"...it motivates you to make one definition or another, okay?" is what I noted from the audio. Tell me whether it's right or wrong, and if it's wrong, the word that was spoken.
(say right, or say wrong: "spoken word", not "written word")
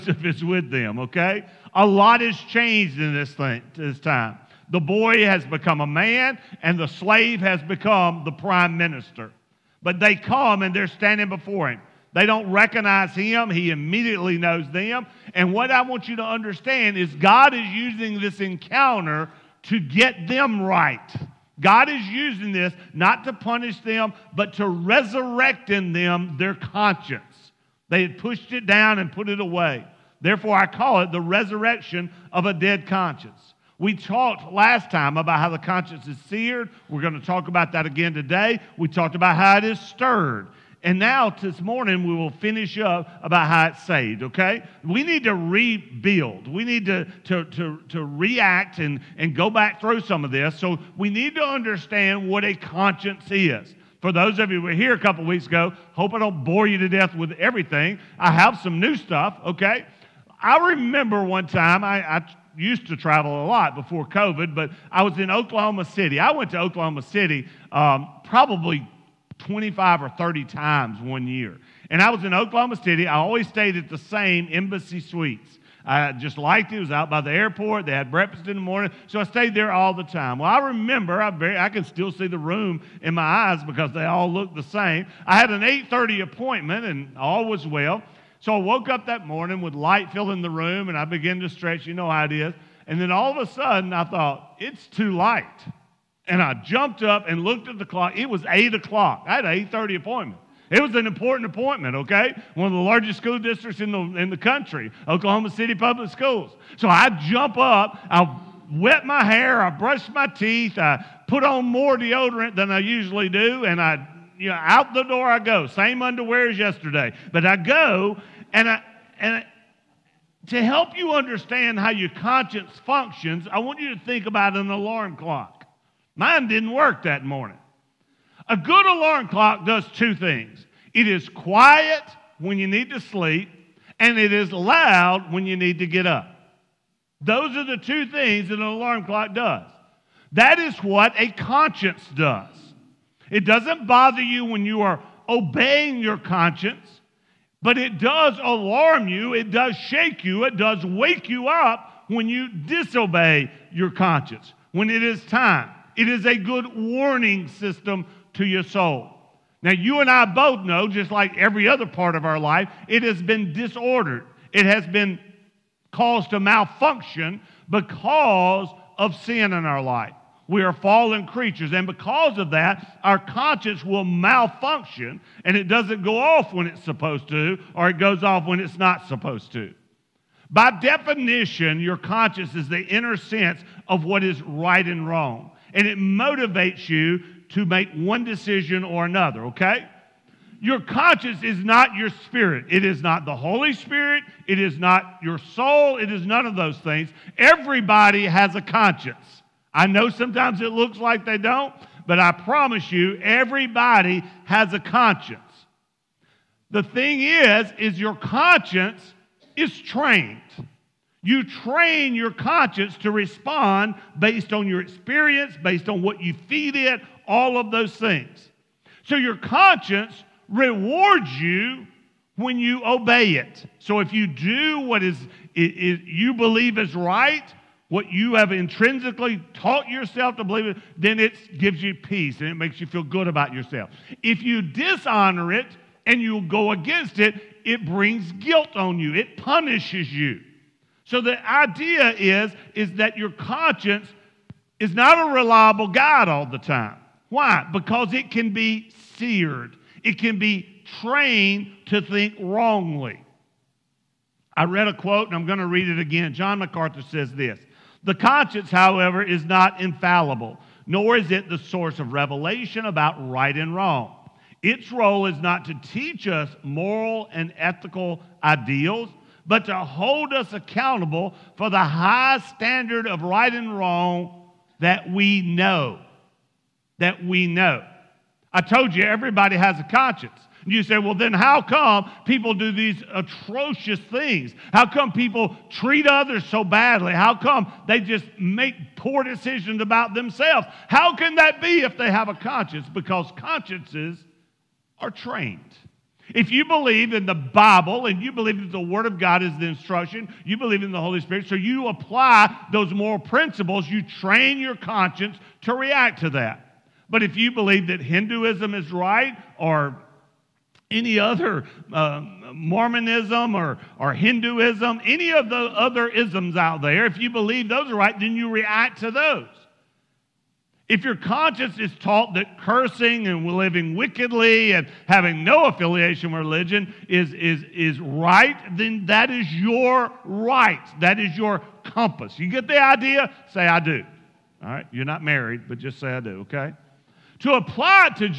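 wrong: "decision", not "definition".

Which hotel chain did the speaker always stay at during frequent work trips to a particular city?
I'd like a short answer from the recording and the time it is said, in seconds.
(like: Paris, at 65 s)
Embassy Suites, at 74 s.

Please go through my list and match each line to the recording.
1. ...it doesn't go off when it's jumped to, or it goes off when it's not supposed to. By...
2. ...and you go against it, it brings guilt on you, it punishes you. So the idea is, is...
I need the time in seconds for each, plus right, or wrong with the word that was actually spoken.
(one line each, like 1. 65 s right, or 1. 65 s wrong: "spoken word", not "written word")
1. 175 s wrong: "supposed", not "jumped"
2. 236 s right.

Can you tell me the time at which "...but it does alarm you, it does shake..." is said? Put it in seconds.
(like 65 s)
147 s.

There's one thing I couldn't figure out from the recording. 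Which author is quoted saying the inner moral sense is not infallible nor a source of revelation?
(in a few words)
John MacArthur.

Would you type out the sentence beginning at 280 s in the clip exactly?
And you say, well, then how come people do these atrocious things?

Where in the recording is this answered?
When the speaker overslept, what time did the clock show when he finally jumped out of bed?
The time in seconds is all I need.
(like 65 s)
98 s.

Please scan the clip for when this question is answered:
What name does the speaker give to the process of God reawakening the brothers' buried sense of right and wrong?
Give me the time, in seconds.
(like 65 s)
31 s.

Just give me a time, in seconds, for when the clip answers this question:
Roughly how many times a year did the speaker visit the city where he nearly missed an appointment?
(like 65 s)
69 s.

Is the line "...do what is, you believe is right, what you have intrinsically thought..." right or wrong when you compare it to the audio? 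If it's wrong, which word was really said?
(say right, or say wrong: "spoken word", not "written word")
wrong: "taught", not "thought".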